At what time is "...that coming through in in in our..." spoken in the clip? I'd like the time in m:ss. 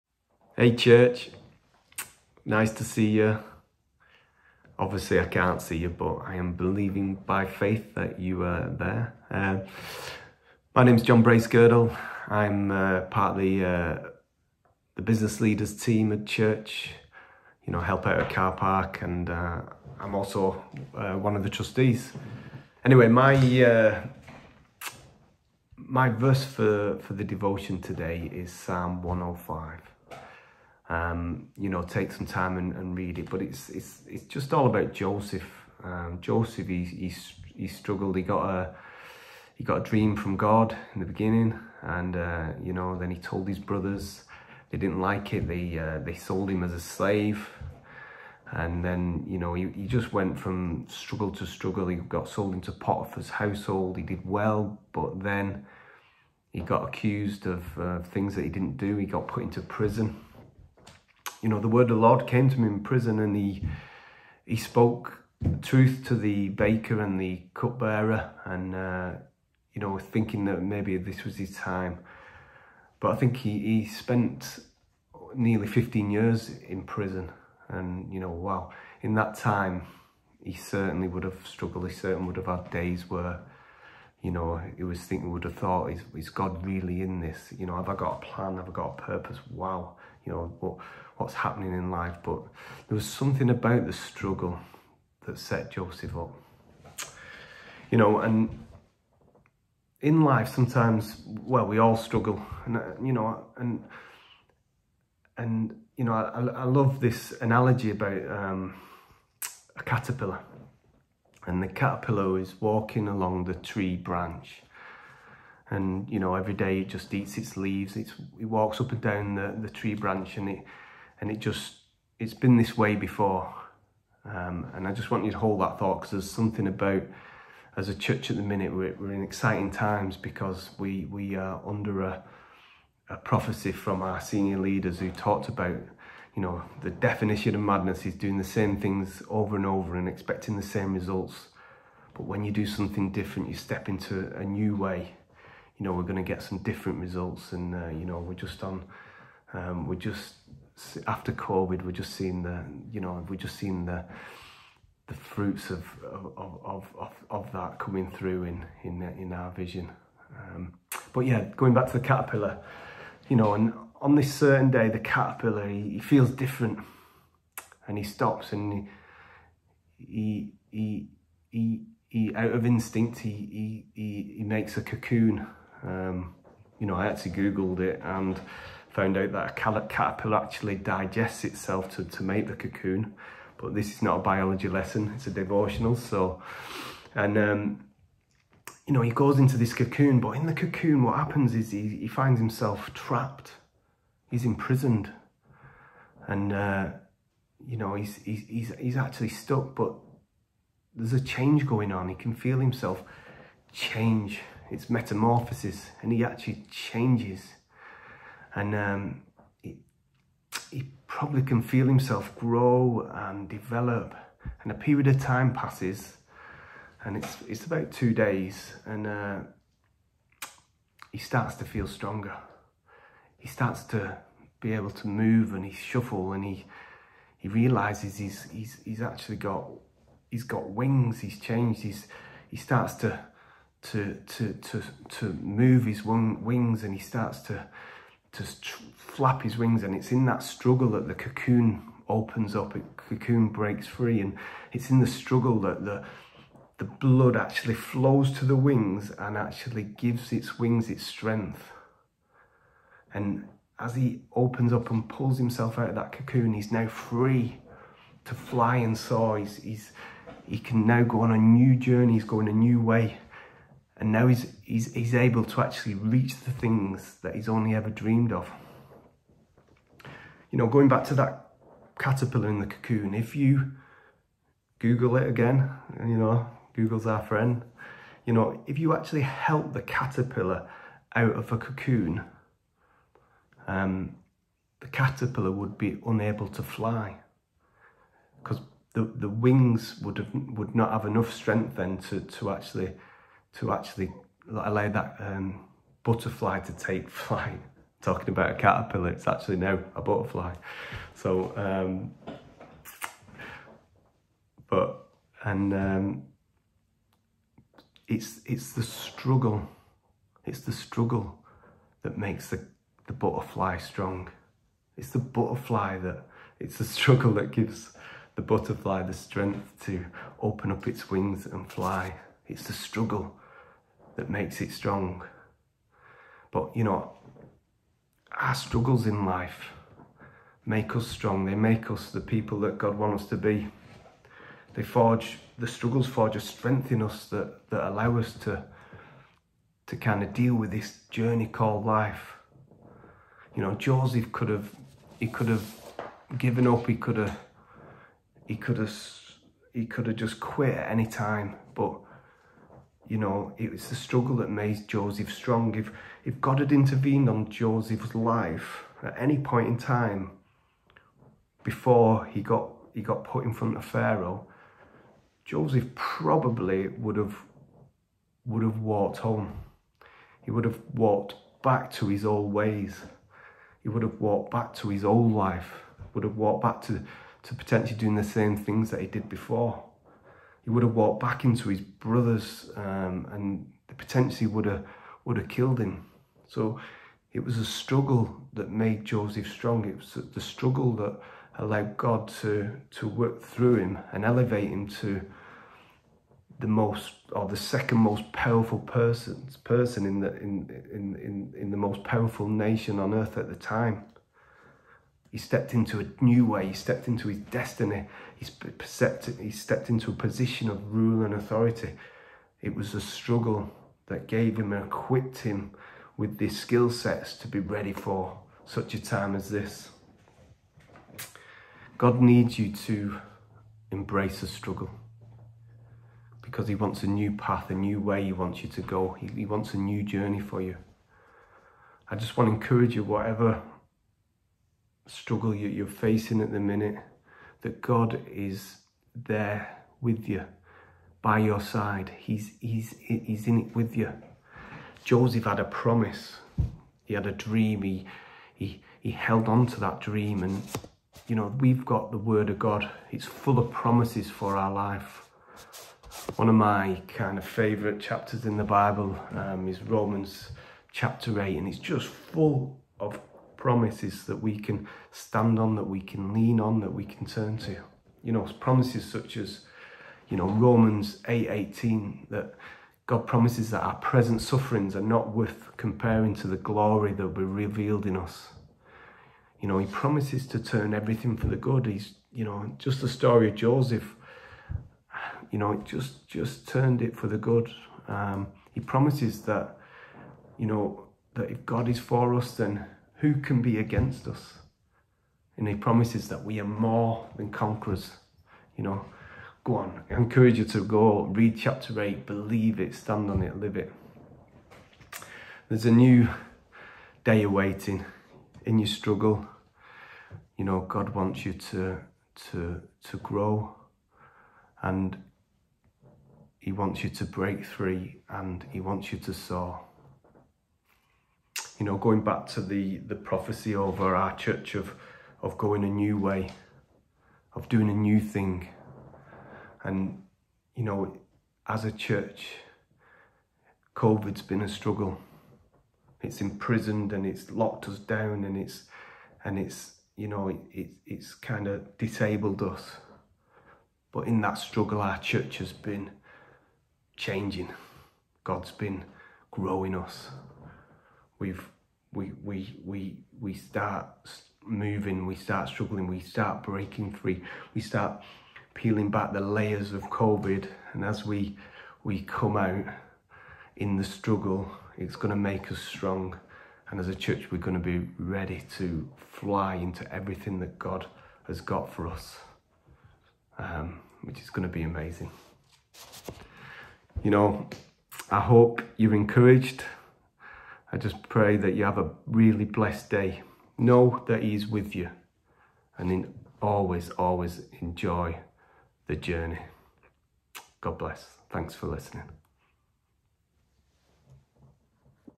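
2:37.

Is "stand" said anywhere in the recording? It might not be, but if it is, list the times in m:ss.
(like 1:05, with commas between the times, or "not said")
7:45, 8:22.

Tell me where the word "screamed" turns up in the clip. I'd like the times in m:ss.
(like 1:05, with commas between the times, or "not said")
not said.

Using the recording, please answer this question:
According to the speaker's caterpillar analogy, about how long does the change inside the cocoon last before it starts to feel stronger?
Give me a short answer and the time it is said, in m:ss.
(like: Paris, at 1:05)
2 days, at 3:37.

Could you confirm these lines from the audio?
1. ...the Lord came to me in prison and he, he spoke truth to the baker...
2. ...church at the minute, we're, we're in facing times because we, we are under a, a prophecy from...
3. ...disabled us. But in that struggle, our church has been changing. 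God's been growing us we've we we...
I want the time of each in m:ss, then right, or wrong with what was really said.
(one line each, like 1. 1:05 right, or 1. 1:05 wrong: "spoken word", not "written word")
1. 1:01 right
2. 2:07 wrong: "exciting", not "facing"
3. 9:01 right.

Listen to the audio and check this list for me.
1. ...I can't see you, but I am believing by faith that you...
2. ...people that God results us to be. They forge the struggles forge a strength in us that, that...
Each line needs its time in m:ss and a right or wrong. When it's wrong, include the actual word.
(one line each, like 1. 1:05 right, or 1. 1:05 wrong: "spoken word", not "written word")
1. 0:05 right
2. 5:32 wrong: "wants", not "results".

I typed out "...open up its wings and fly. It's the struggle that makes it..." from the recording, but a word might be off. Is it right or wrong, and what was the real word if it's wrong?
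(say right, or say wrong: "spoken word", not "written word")
right.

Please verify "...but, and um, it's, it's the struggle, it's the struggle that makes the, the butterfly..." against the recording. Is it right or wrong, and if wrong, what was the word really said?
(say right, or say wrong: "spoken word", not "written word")
right.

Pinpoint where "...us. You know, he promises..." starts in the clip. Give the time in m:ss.
7:58.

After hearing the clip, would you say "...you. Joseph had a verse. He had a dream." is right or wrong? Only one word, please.
wrong.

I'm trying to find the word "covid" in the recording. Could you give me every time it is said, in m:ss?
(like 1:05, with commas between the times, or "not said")
2:31, 8:53, 9:20.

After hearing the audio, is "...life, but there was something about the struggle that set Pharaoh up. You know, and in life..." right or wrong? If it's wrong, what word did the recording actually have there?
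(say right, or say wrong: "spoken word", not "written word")
wrong: "Joseph", not "Pharaoh".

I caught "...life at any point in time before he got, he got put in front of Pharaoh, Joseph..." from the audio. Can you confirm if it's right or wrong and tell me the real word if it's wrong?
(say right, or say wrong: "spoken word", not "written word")
right.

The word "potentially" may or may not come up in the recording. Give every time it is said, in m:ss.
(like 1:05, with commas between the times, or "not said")
6:17, 6:23.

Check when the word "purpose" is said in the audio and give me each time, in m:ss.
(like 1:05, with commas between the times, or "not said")
1:29.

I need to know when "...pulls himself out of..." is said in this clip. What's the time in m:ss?
4:15.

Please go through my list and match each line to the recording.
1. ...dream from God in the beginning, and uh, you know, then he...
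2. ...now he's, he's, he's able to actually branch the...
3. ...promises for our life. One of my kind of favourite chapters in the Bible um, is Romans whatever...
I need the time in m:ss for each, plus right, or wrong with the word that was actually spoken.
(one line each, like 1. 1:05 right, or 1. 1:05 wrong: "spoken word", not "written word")
1. 0:39 right
2. 4:24 wrong: "reach", not "branch"
3. 7:33 wrong: "chapter", not "whatever".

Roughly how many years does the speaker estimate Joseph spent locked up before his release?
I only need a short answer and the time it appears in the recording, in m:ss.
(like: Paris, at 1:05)
15, at 1:15.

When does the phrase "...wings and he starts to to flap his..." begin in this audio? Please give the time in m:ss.
3:56.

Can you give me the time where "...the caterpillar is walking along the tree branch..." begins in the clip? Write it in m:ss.
1:51.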